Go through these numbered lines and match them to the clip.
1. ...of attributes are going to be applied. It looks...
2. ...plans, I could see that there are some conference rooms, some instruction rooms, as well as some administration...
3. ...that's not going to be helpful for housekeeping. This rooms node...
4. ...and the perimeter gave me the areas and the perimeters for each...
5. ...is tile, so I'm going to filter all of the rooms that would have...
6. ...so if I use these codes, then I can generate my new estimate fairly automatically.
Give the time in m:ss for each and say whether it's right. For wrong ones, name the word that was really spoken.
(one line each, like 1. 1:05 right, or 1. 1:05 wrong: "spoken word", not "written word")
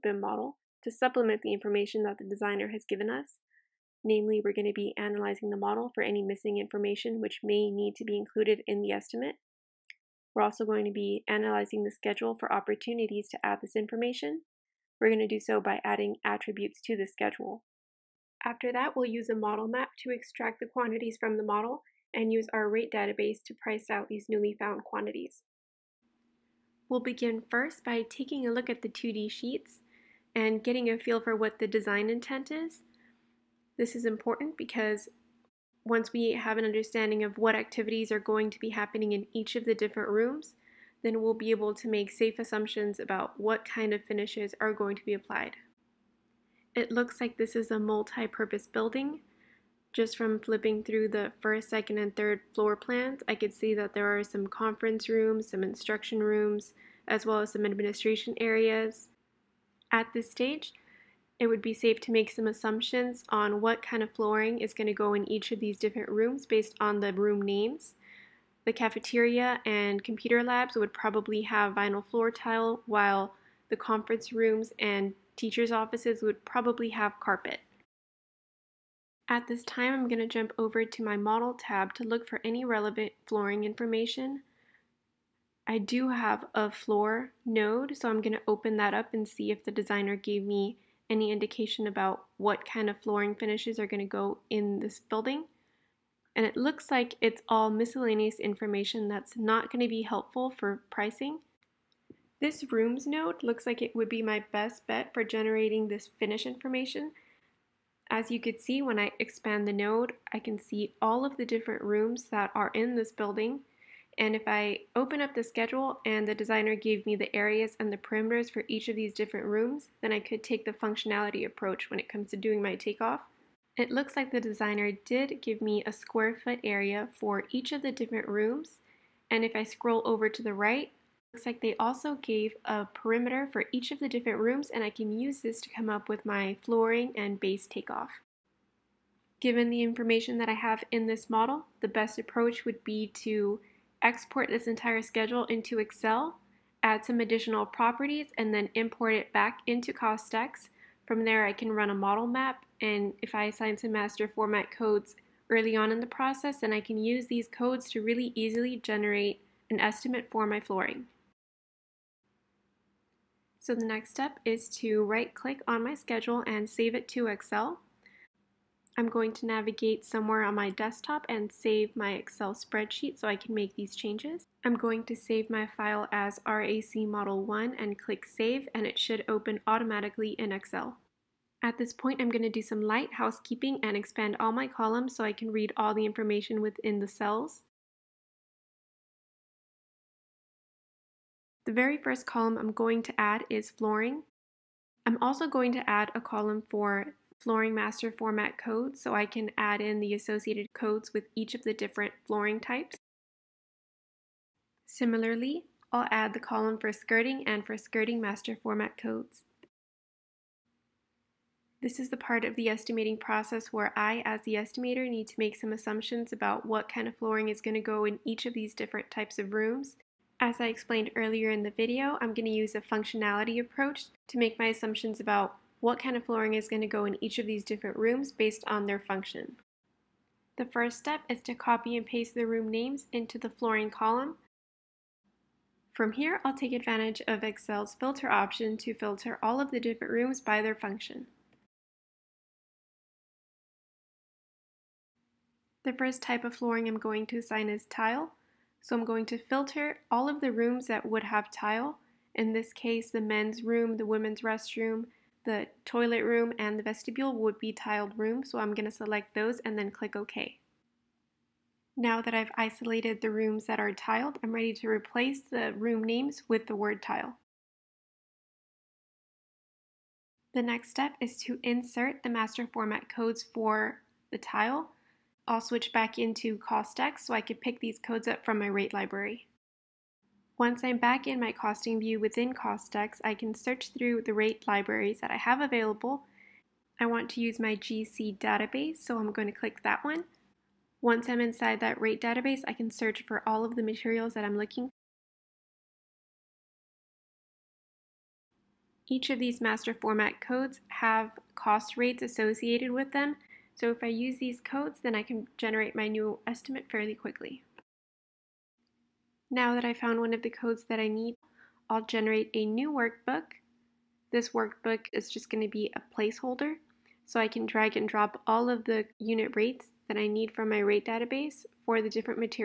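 1. 0:43 wrong: "finishes", not "attributes"
2. 0:52 right
3. 1:39 wrong: "pricing", not "housekeeping"
4. 1:56 wrong: "designer", not "perimeter"
5. 4:07 right
6. 5:03 wrong: "quickly", not "automatically".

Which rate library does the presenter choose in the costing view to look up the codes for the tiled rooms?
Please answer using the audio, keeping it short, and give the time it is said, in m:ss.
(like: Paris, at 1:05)
GC database, at 4:47.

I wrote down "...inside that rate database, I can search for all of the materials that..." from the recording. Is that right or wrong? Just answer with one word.
right.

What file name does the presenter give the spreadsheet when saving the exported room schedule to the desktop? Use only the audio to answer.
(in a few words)
RAC Model 1.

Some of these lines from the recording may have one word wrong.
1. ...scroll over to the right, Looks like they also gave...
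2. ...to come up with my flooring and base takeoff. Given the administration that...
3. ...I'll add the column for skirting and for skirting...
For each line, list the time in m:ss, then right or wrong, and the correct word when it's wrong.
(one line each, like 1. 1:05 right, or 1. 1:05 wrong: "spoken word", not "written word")
1. 2:09 right
2. 2:15 wrong: "information", not "administration"
3. 3:25 right.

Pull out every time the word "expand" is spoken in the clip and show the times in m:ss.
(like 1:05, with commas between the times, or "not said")
1:49, 3:03.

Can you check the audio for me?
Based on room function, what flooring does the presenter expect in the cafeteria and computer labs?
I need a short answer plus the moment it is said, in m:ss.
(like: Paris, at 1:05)
Vinyl floor tile, at 1:11.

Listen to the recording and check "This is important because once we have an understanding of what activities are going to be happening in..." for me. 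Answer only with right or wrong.
right.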